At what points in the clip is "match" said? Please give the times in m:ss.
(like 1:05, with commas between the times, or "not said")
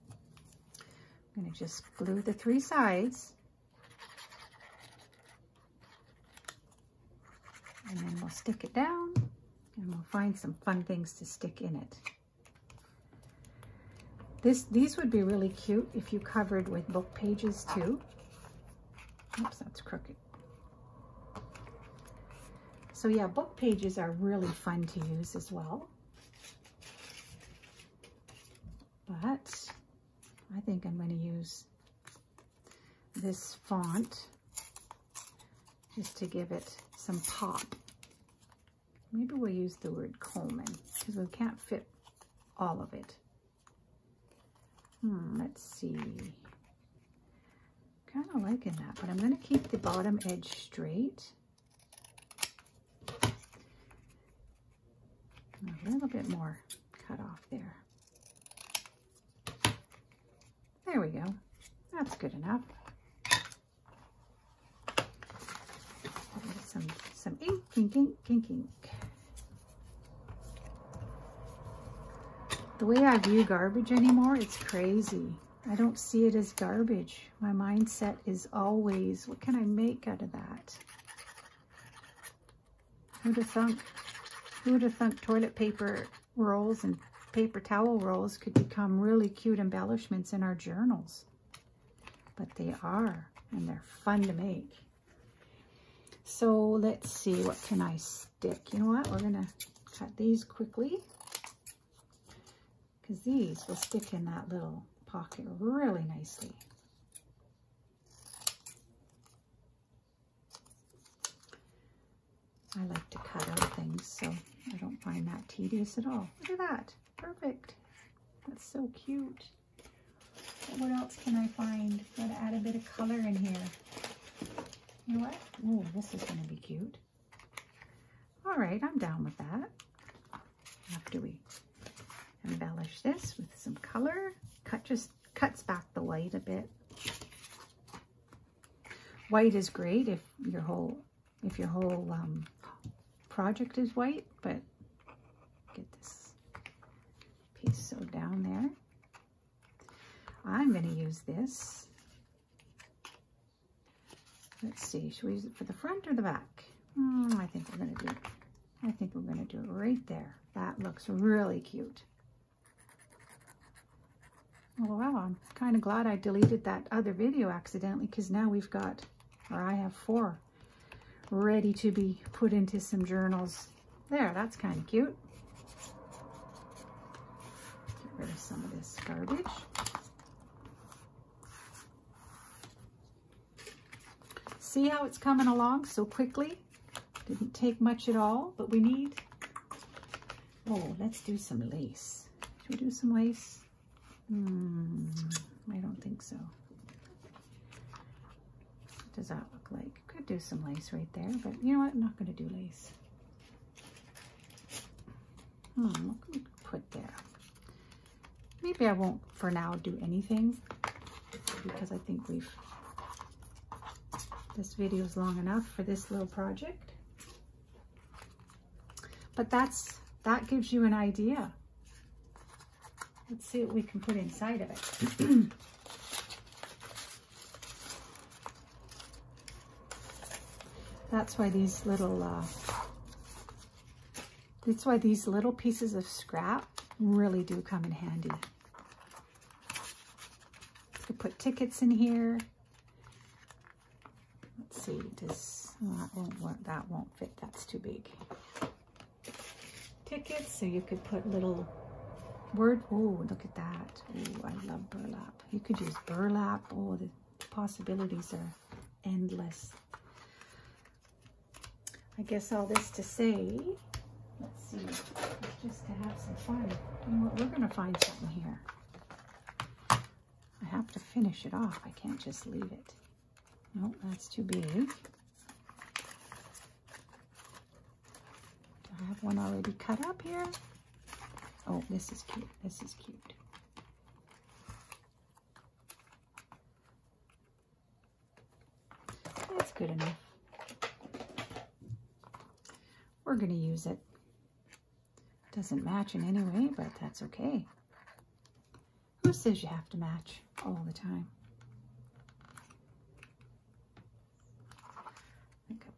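4:55, 4:59.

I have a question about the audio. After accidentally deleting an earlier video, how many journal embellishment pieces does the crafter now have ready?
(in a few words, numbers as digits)
4.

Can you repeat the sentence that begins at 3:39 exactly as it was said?
But that's, that gives you an idea.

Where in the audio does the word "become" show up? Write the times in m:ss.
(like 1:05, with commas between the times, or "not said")
1:28.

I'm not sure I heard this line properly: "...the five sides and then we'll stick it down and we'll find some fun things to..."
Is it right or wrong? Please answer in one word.
wrong.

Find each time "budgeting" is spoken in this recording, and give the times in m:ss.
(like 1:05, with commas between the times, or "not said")
not said.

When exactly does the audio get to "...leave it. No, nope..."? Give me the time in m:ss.
4:32.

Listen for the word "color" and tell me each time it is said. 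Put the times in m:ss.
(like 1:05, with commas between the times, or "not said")
2:02, 2:13.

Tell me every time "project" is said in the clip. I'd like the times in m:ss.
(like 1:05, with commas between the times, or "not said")
2:23, 3:36.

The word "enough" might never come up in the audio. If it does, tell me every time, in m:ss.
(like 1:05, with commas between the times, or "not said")
1:02, 3:35, 4:49.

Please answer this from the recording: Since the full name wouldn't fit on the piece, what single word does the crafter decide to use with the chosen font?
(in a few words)
Coleman.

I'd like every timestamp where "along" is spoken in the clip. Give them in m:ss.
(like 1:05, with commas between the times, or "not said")
3:05.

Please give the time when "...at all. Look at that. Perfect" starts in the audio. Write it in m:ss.
1:55.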